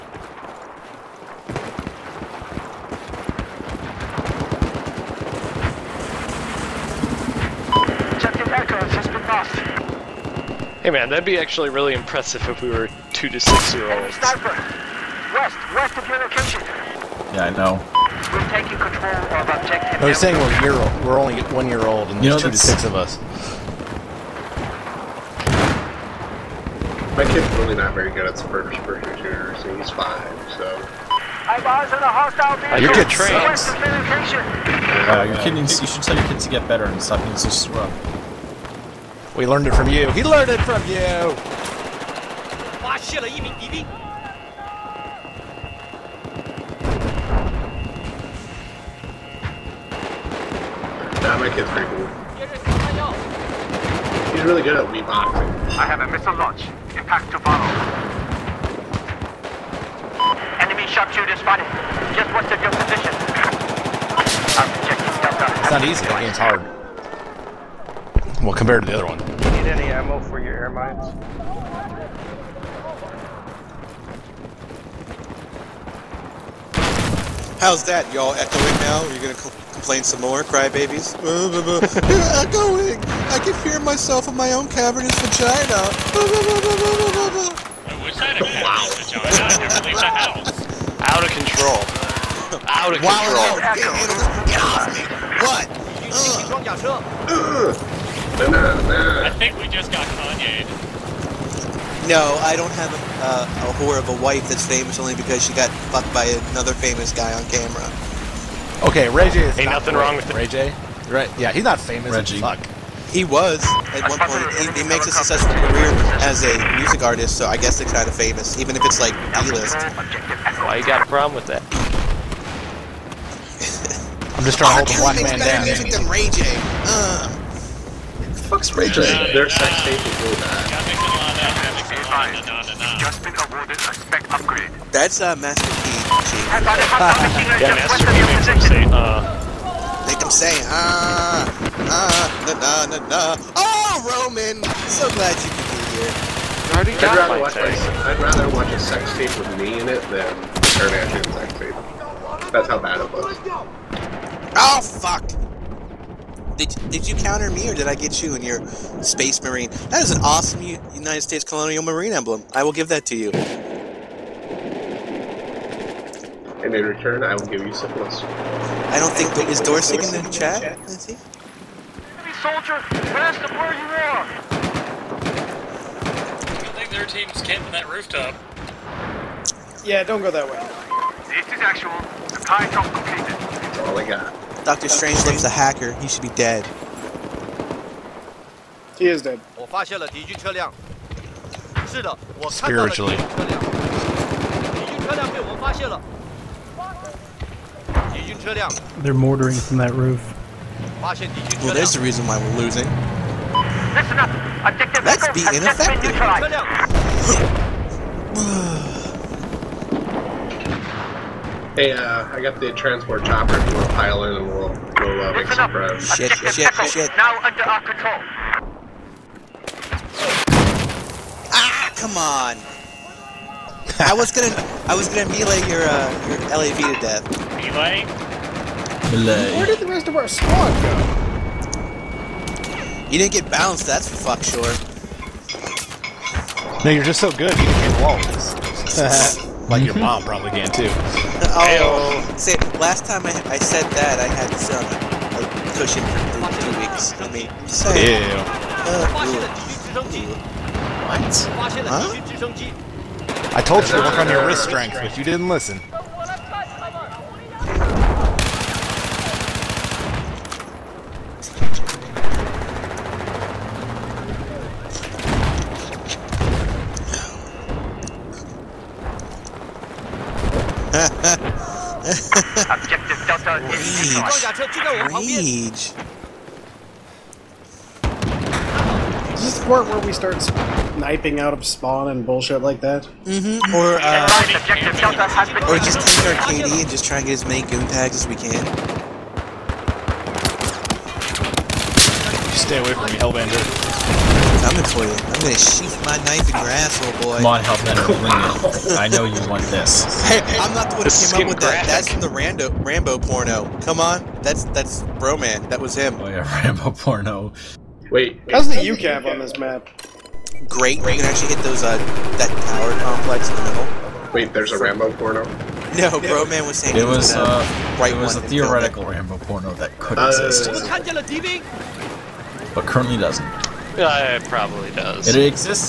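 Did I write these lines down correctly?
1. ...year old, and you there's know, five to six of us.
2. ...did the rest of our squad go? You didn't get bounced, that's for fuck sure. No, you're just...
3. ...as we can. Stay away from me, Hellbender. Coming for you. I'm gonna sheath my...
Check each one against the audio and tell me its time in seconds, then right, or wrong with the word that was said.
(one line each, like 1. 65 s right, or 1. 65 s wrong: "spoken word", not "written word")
1. 21 s wrong: "two", not "five"
2. 229 s right
3. 288 s right.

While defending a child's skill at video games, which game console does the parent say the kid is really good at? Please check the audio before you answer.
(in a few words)
Wii.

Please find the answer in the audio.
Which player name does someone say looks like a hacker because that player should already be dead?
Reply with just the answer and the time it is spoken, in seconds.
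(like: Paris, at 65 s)
Doctor Strange, at 184 s.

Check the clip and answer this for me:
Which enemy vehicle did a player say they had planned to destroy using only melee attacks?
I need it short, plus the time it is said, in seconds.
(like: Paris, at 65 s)
LAV, at 226 s.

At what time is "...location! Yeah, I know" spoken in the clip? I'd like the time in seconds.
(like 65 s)
16 s.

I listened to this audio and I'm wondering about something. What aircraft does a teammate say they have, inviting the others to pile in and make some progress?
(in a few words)
Transport chopper.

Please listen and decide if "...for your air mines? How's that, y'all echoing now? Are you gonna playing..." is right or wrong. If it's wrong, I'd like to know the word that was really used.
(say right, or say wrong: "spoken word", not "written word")
right.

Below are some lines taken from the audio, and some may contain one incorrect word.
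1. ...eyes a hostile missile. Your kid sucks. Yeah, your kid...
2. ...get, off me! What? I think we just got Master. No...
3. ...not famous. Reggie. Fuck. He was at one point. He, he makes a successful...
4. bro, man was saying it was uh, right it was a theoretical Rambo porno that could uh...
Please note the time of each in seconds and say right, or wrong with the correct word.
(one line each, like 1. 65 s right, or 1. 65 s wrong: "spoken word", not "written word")
1. 31 s wrong: "vehicle", not "missile"
2. 94 s wrong: "Kanye", not "Master"
3. 111 s right
4. 316 s right.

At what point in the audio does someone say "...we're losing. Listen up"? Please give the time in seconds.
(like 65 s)
202 s.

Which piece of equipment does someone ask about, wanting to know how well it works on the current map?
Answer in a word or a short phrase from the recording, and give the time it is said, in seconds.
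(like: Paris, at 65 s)
UCAV, at 308 s.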